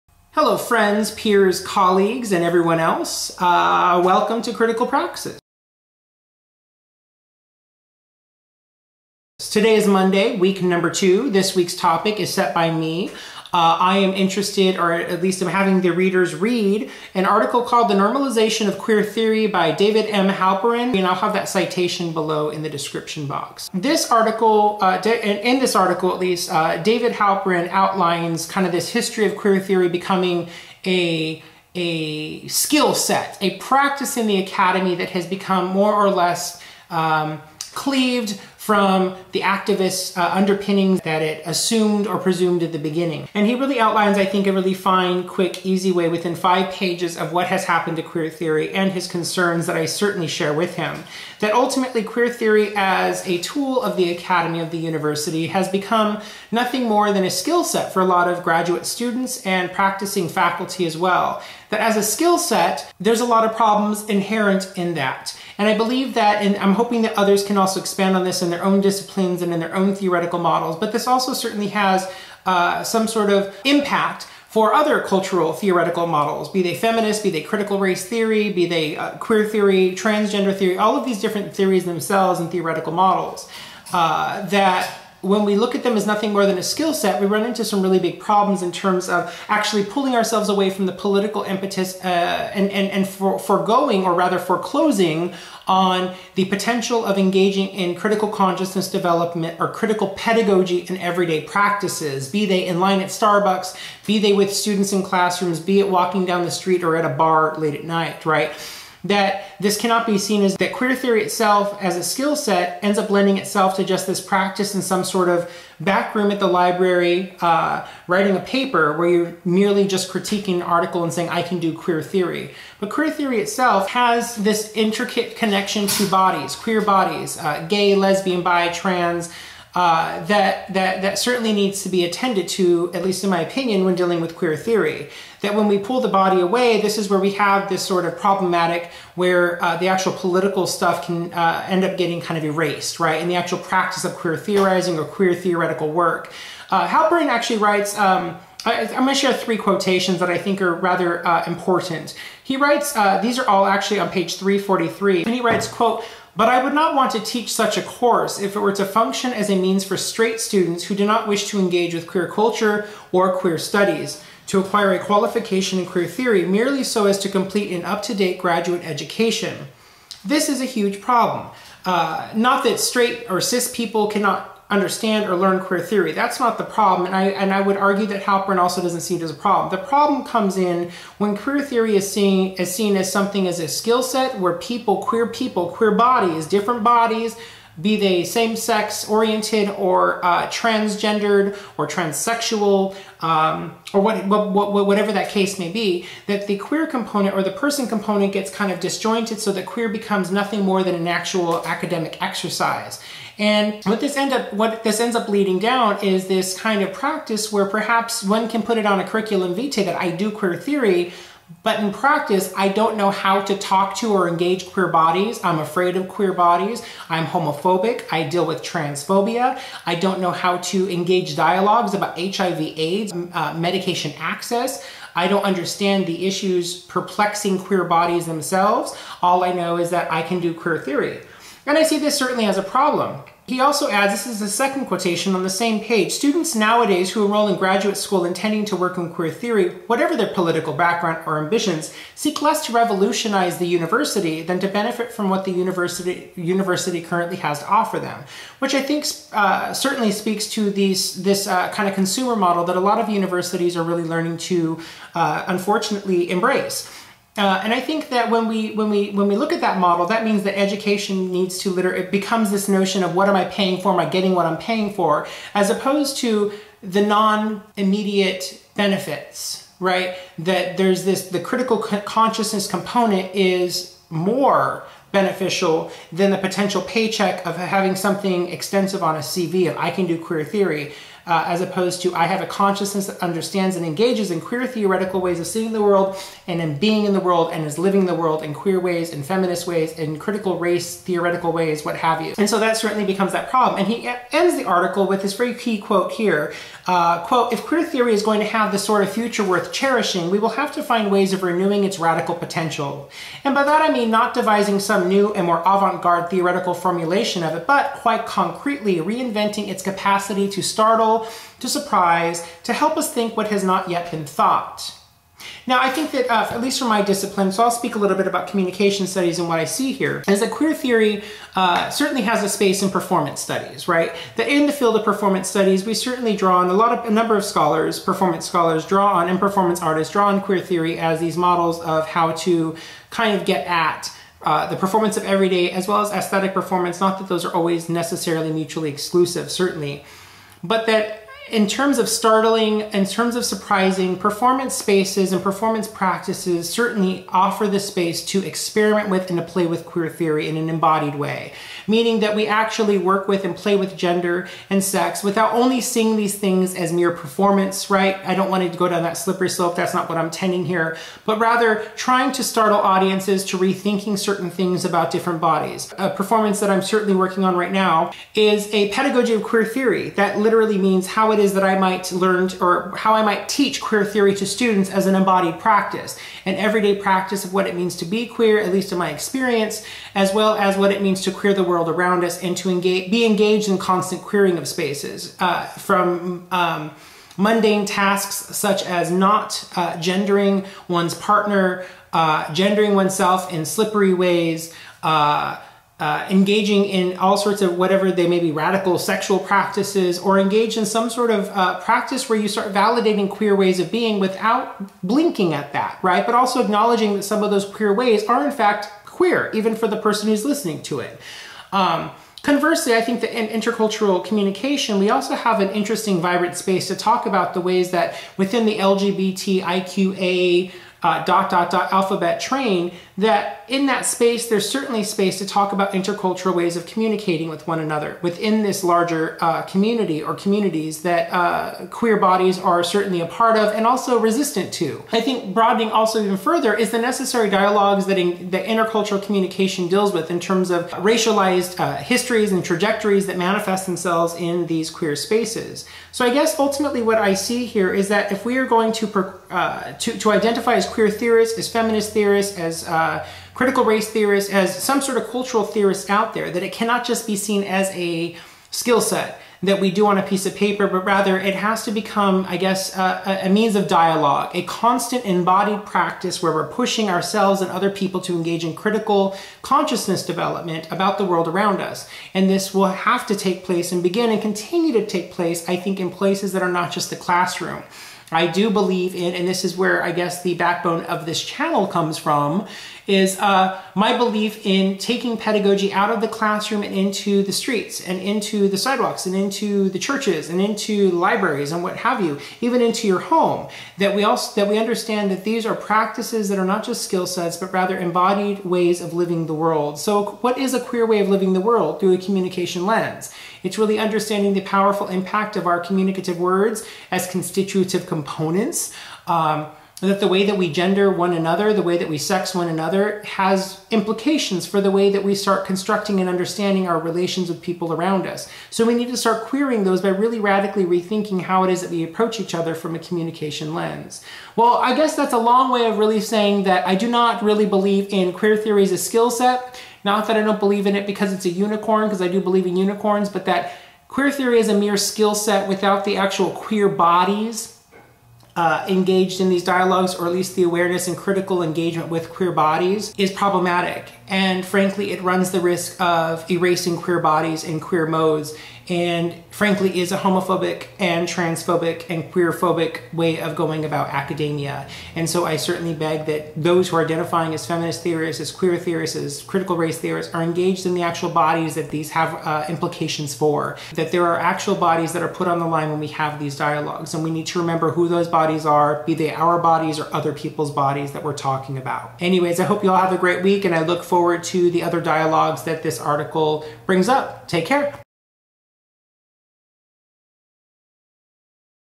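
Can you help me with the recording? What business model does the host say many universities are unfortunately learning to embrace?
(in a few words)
consumer model.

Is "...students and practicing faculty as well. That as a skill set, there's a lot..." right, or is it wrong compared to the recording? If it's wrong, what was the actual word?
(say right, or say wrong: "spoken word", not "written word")
right.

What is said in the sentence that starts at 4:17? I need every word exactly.
Uh, and I think that when we when we when we look at that model, that means that education needs to liter.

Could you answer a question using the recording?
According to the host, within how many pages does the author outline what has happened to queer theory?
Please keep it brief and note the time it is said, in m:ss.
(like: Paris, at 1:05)
5, at 0:46.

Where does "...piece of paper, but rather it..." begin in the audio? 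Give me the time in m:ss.
7:40.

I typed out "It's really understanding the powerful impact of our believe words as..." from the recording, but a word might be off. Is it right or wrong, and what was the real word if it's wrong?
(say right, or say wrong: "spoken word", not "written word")
wrong: "communicative", not "believe".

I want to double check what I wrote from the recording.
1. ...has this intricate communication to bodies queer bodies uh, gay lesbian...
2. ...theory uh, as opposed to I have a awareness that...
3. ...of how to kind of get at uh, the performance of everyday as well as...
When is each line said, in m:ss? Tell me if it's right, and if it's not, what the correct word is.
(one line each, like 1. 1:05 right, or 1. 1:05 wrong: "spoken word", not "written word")
1. 2:03 wrong: "connection", not "communication"
2. 4:40 wrong: "consciousness", not "awareness"
3. 5:31 right.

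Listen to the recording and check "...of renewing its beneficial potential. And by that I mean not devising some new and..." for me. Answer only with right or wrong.
wrong.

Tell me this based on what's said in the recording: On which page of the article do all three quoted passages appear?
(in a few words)
343.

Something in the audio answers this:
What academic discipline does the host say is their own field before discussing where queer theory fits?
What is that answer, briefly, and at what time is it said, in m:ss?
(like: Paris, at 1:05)
communication studies, at 5:18.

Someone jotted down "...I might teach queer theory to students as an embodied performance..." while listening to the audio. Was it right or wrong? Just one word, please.
wrong.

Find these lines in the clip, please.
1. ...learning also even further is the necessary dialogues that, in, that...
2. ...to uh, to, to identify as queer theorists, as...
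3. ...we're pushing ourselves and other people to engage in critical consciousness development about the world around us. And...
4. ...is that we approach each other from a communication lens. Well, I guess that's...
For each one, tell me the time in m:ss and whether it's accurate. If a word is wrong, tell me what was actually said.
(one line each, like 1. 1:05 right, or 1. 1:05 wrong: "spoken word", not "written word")
1. 7:15 wrong: "broadening", not "learning"
2. 7:28 right
3. 7:46 right
4. 8:41 right.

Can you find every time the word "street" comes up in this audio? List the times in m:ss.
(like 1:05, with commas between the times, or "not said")
1:46, 8:07.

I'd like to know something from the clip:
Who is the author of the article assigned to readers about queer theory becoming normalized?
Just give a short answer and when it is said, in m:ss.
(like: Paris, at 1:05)
David M. Halperin, at 0:19.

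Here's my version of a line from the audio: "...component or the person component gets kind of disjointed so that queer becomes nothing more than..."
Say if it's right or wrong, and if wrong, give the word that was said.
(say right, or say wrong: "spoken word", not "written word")
right.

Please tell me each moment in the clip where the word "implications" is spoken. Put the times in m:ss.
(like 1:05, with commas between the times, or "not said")
8:33, 9:22.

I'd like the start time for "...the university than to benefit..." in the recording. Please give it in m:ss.
4:03.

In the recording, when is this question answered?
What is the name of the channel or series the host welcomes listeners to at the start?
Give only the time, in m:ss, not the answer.
0:04.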